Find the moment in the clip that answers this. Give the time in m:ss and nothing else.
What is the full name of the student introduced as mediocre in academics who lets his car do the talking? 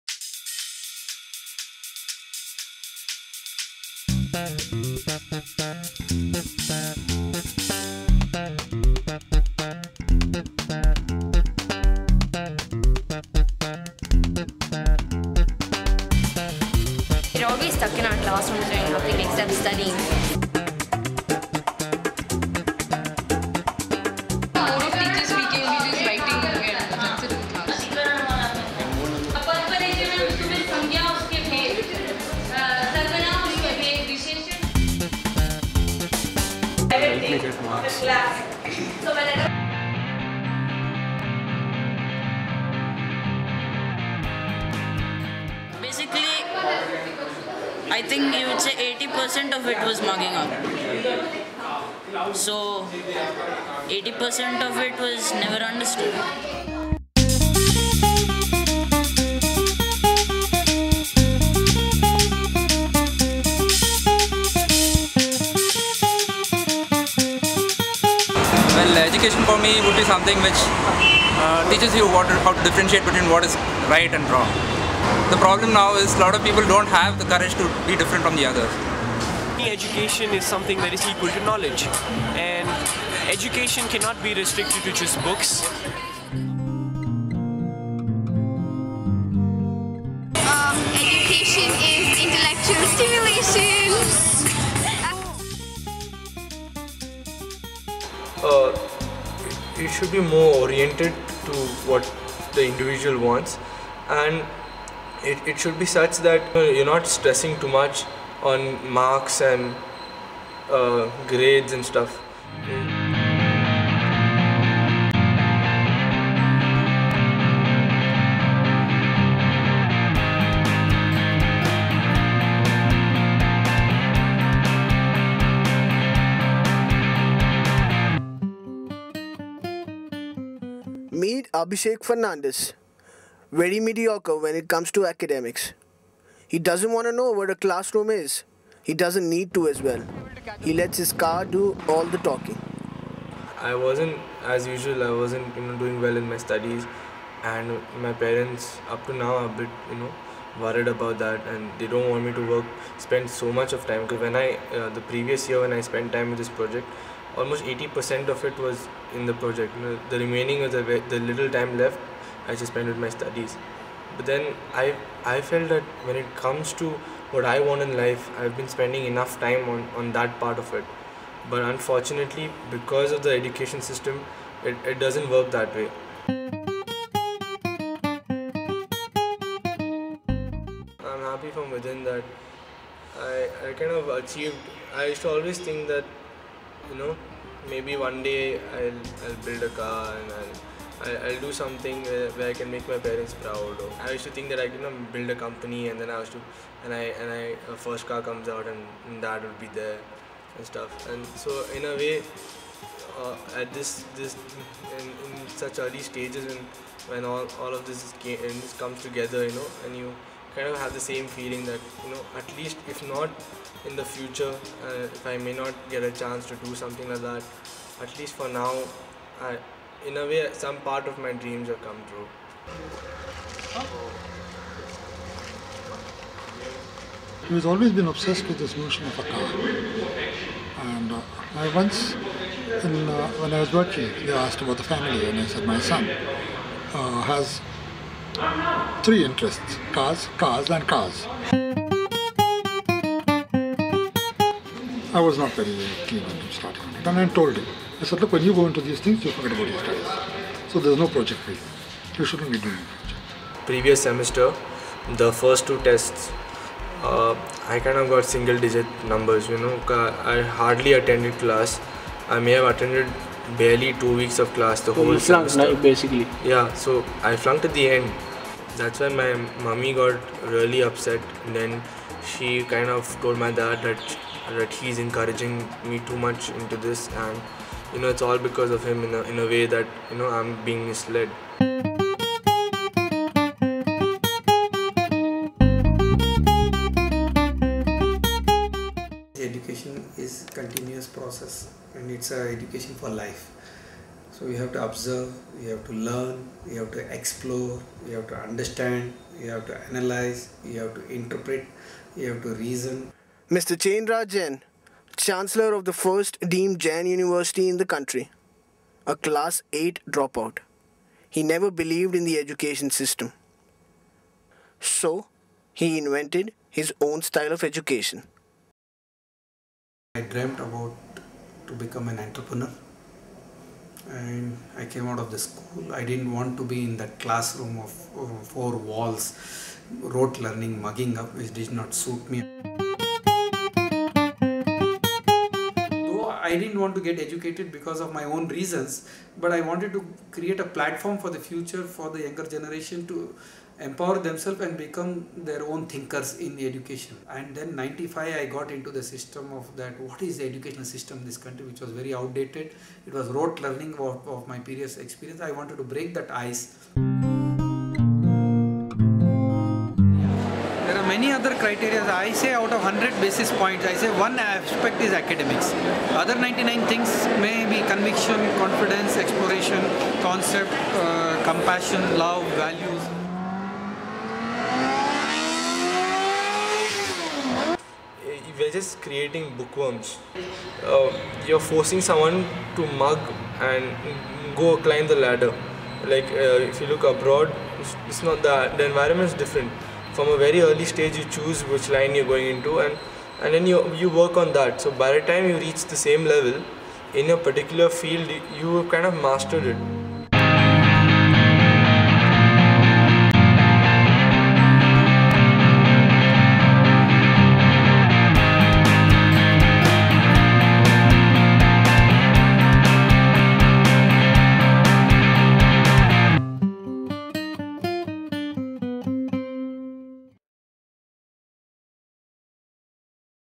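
2:11.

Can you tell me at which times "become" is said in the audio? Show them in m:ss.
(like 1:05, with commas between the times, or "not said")
5:21, 5:44.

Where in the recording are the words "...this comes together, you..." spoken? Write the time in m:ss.
3:28.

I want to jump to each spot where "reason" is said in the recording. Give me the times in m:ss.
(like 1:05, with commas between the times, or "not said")
5:02, 5:38.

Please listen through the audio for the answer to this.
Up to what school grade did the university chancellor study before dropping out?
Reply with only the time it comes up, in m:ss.
5:09.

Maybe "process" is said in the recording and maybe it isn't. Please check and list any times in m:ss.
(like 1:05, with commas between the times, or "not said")
4:51.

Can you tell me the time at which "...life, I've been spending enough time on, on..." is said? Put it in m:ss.
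2:47.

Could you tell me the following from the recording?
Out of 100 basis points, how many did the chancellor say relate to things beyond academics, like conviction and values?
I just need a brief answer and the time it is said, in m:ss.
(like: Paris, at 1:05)
99, at 6:06.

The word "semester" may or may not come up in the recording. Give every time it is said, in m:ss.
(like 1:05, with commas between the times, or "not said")
4:14, 4:25.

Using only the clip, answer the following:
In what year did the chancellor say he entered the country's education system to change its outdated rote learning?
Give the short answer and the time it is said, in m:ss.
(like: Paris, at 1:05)
1995, at 5:47.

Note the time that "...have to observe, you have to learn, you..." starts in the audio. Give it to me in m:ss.
4:54.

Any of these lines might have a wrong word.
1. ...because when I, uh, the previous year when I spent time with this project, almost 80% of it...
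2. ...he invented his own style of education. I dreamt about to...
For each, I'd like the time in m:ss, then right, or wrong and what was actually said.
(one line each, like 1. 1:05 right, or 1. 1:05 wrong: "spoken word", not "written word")
1. 2:34 right
2. 5:15 right.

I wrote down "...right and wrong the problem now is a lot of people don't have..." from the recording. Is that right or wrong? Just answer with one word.
right.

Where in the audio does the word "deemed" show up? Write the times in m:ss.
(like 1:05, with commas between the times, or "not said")
5:06.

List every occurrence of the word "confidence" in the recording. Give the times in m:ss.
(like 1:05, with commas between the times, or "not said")
6:08.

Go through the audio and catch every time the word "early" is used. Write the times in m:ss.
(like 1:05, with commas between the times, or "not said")
3:25, 6:30.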